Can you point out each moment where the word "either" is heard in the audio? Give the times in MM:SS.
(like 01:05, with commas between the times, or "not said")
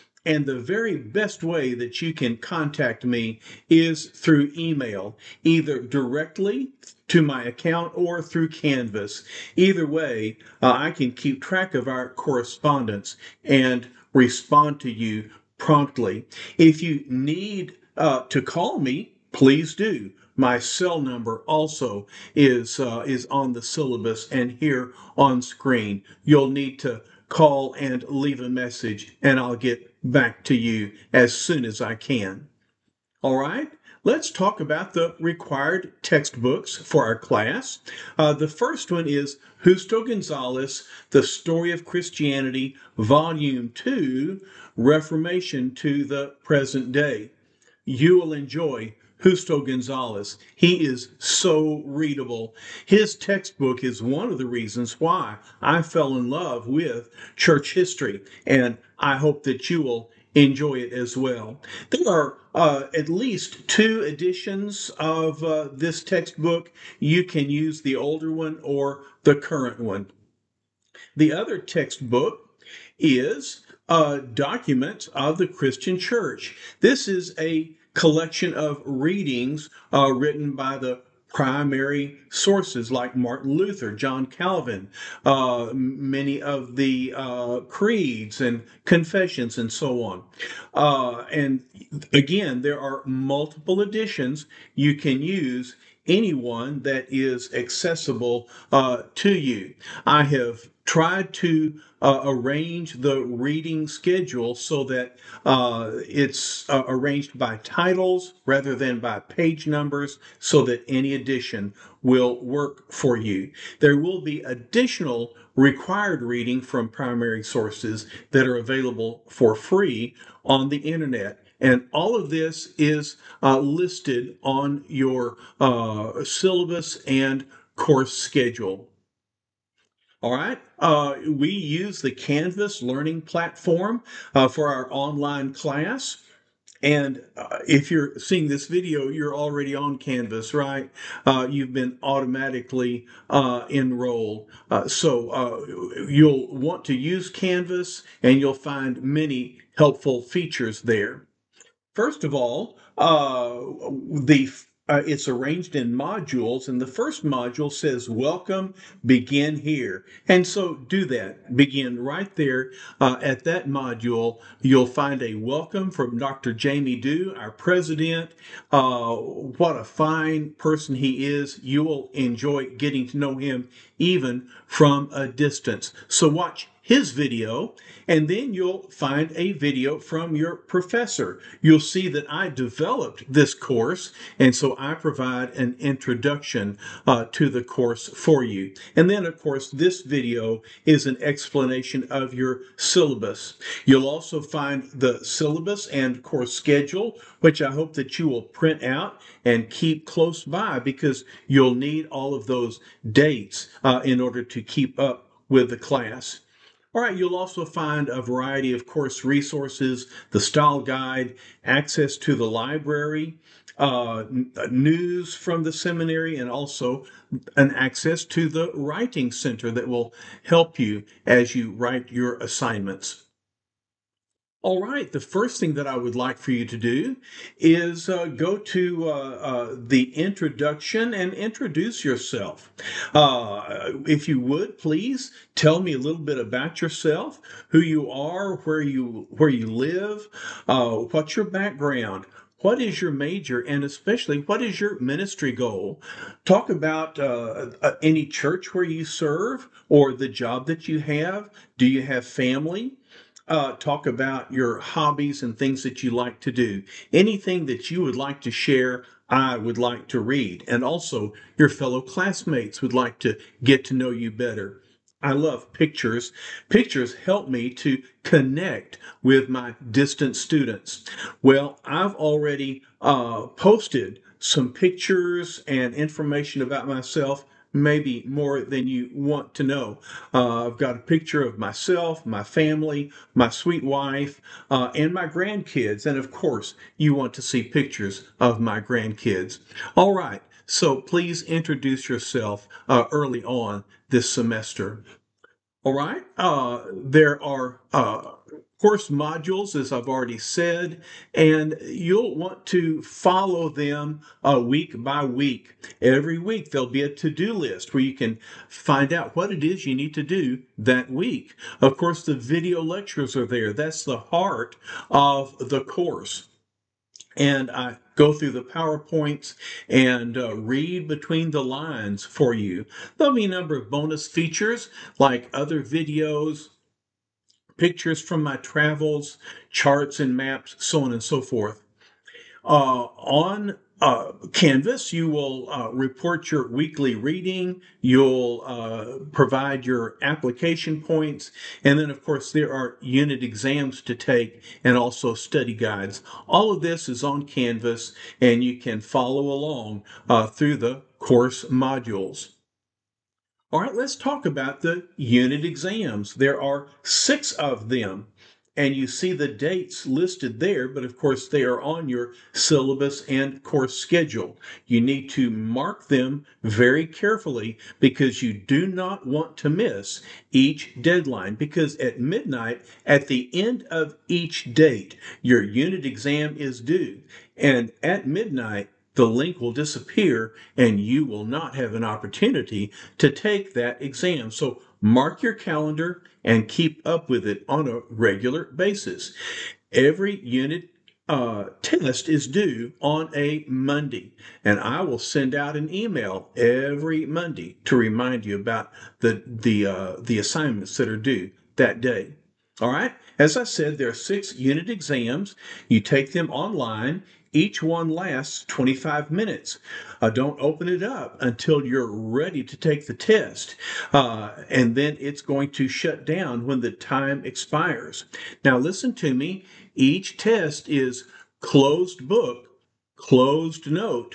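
00:05, 00:09.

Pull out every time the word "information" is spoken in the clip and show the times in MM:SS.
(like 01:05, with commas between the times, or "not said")
04:35.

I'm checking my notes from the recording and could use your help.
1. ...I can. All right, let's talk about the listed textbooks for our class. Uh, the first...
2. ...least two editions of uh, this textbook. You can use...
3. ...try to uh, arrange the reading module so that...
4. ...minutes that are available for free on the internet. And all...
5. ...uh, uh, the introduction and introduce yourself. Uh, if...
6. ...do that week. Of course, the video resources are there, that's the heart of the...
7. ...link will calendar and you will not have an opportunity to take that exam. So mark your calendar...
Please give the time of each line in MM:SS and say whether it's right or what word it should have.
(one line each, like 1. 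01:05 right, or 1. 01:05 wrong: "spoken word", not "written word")
1. 00:31 wrong: "required", not "listed"
2. 01:03 right
3. 01:40 wrong: "schedule", not "module"
4. 01:57 wrong: "sources", not "minutes"
5. 03:49 right
6. 05:10 wrong: "lectures", not "resources"
7. 06:19 wrong: "disappear", not "calendar".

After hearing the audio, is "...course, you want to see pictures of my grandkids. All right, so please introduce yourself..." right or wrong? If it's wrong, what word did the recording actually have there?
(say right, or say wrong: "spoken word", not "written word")
right.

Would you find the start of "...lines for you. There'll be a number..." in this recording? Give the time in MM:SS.
05:21.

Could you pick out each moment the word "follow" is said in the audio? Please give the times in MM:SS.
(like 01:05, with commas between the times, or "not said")
05:03, 05:49.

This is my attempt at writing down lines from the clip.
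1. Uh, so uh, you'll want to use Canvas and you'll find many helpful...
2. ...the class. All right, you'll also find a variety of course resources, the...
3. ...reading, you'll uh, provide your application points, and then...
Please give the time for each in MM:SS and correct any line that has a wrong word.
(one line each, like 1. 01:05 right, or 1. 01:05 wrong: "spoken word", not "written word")
1. 02:24 right
2. 03:25 right
3. 05:37 right.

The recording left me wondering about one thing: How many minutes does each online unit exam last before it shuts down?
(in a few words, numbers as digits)
25.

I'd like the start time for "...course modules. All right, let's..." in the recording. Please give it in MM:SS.
05:51.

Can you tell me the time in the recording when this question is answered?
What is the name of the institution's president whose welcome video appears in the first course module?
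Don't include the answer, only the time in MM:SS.
02:46.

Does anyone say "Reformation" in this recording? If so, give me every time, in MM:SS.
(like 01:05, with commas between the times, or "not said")
00:44.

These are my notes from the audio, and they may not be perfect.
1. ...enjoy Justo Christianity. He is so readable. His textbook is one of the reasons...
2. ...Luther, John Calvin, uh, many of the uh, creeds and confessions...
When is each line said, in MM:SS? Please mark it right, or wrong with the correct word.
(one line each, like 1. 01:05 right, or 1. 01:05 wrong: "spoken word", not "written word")
1. 00:48 wrong: "Gonzalez", not "Christianity"
2. 01:23 right.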